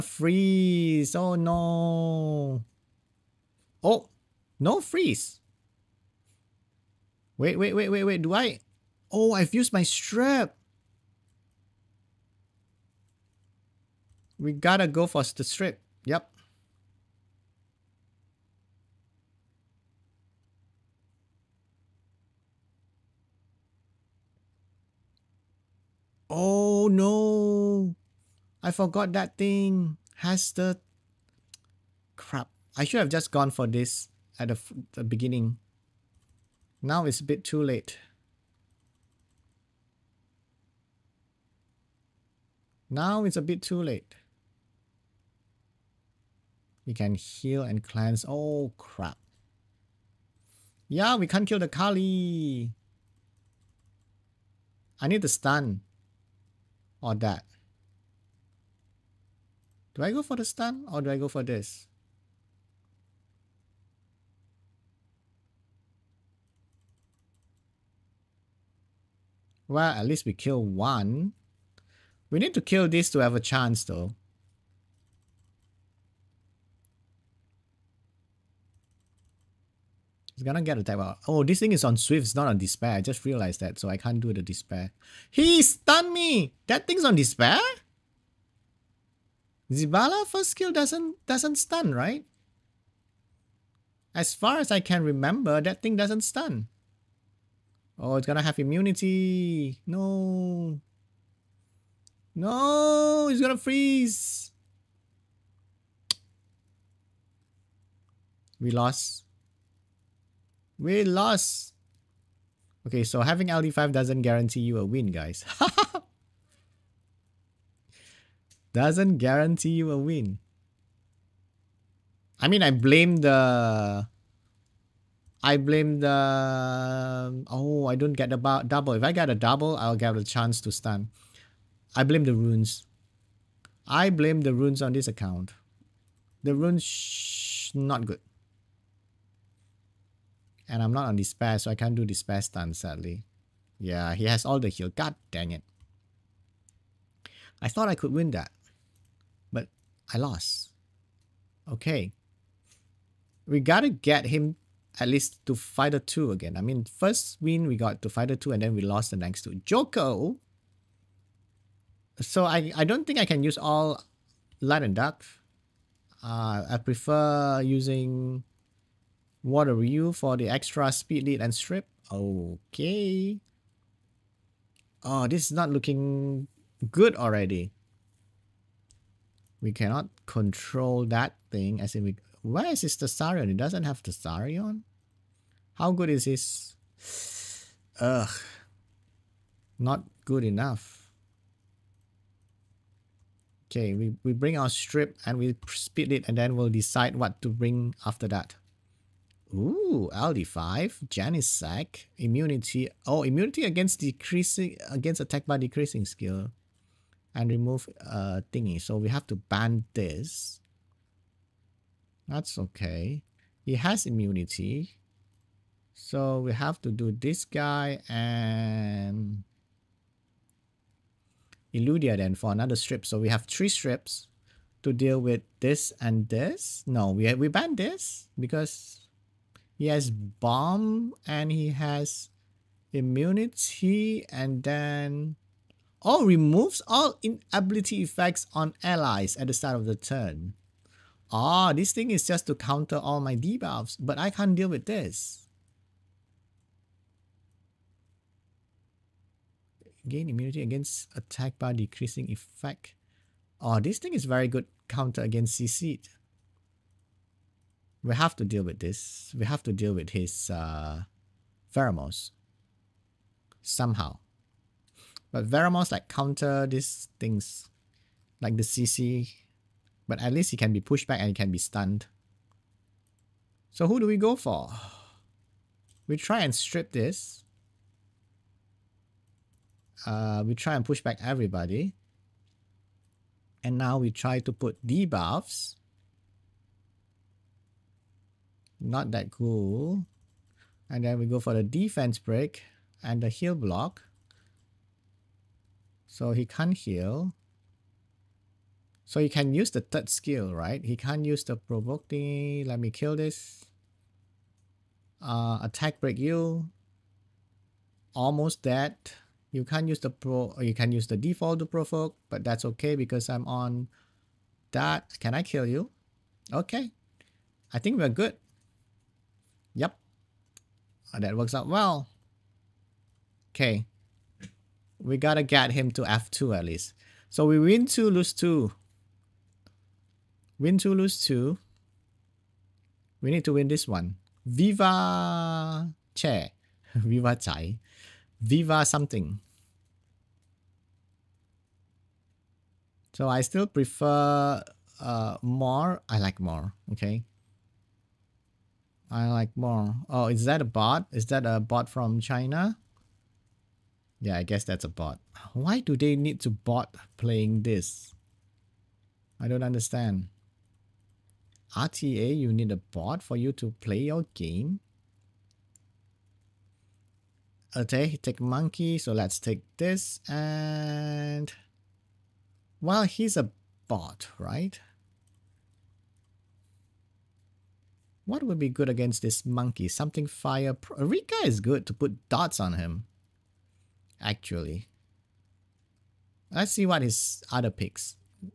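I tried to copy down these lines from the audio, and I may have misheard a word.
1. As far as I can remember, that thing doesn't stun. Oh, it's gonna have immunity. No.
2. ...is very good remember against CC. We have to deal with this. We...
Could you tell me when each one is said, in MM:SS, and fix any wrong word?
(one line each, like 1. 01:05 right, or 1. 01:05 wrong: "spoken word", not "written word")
1. 01:34 right
2. 04:14 wrong: "counter", not "remember".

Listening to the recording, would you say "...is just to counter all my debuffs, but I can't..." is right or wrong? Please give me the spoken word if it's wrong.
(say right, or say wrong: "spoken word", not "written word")
right.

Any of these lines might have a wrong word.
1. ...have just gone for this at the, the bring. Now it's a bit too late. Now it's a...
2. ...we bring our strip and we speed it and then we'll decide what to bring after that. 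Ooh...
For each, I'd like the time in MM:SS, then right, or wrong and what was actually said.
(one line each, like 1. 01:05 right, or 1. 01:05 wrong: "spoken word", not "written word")
1. 00:32 wrong: "beginning", not "bring"
2. 03:14 right.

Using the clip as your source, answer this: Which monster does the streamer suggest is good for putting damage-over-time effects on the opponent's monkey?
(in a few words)
Rika.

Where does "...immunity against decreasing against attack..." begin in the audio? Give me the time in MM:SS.
03:23.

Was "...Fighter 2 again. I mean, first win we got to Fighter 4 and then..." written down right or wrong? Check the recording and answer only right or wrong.
wrong.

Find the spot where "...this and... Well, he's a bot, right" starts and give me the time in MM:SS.
06:09.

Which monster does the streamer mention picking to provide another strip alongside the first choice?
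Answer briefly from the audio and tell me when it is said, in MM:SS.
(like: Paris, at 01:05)
Illudia, at 03:41.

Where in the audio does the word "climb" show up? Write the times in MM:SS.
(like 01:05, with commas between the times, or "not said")
not said.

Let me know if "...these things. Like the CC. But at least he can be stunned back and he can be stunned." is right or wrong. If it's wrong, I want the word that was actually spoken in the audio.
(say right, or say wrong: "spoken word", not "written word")
wrong: "pushed", not "stunned".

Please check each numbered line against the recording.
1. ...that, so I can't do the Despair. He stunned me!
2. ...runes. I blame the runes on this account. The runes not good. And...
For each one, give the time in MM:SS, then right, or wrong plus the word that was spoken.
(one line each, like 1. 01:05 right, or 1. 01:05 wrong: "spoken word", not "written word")
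1. 01:23 right
2. 02:12 right.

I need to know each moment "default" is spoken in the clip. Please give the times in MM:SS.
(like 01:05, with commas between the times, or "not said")
05:11.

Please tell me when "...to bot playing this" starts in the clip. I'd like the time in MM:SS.
05:56.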